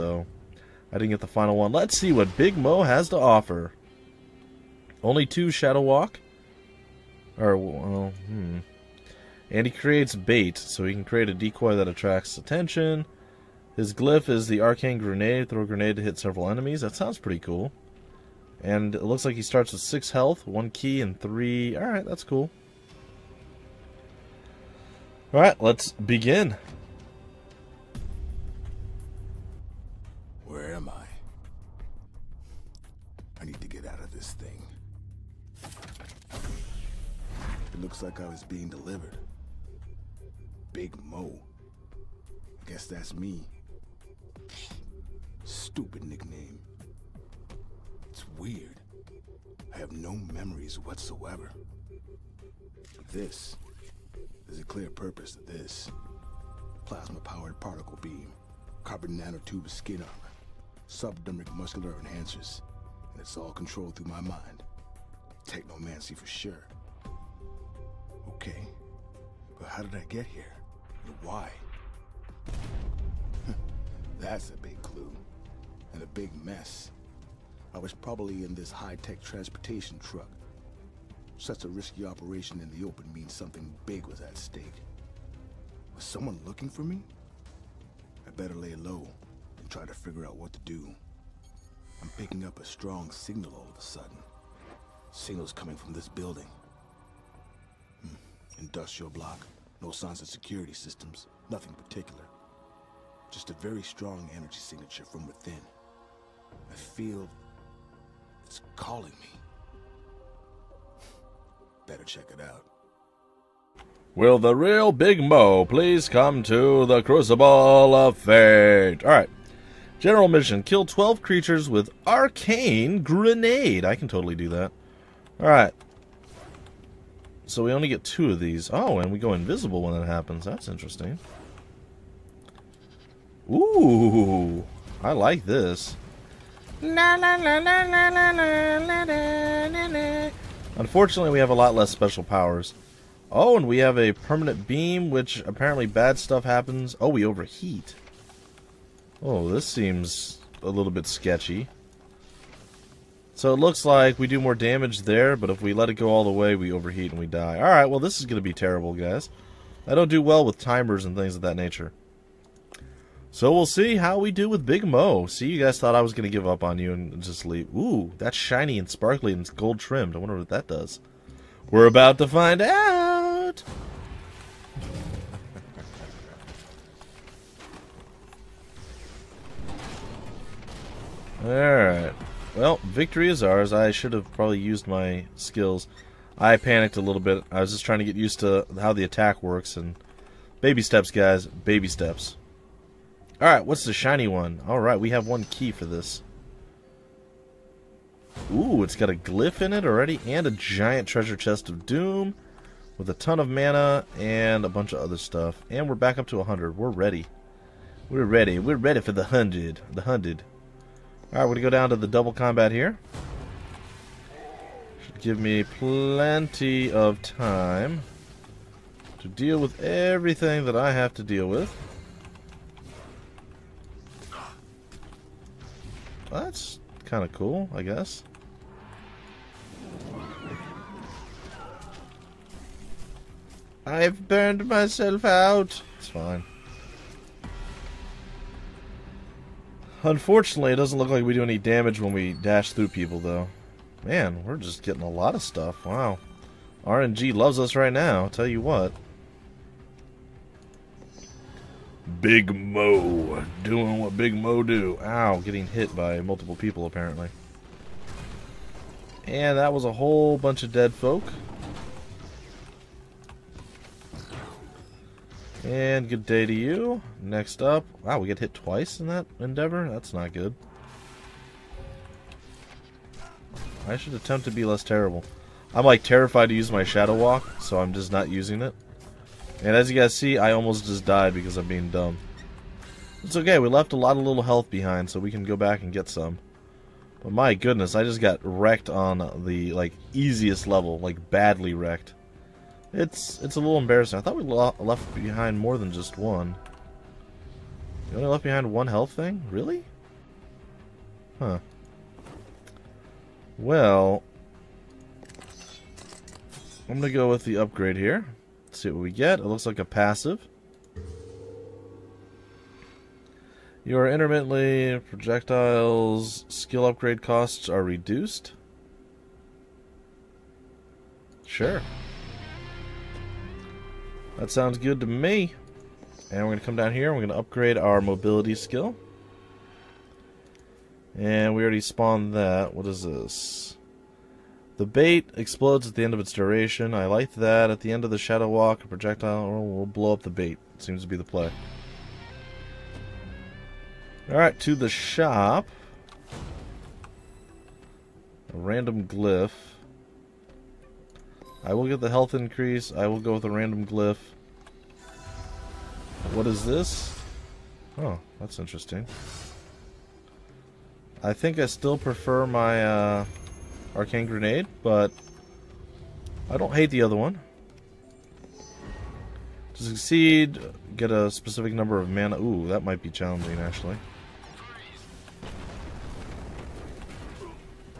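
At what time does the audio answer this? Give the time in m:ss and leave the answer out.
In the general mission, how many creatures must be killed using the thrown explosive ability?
2:00.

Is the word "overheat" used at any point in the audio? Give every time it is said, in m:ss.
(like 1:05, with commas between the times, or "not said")
2:27, 2:36.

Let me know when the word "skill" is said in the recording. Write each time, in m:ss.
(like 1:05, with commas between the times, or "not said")
3:05, 5:16, 5:28.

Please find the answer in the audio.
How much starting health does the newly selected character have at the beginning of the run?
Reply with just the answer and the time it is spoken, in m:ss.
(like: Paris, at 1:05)
6, at 0:19.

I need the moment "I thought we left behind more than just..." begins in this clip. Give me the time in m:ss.
4:54.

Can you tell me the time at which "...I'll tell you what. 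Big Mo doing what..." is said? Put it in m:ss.
4:08.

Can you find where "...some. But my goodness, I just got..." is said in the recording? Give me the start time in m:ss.
4:46.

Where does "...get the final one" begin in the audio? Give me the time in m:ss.
0:01.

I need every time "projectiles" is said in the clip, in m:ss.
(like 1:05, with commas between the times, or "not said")
5:15, 5:38.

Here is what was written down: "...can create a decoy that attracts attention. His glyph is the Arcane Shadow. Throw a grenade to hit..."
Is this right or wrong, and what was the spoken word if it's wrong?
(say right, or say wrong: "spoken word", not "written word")
wrong: "Grenade", not "Shadow".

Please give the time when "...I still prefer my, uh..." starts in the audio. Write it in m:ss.
6:01.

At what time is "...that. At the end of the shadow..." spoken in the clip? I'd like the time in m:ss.
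5:37.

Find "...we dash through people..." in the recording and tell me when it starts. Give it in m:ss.
4:02.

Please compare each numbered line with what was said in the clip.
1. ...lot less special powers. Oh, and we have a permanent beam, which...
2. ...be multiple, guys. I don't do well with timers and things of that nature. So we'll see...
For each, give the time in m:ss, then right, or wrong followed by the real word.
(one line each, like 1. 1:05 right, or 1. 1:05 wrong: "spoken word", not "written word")
1. 2:21 right
2. 2:38 wrong: "terrible", not "multiple".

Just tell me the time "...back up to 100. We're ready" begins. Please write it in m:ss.
3:25.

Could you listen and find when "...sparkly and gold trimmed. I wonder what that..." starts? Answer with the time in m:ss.
2:48.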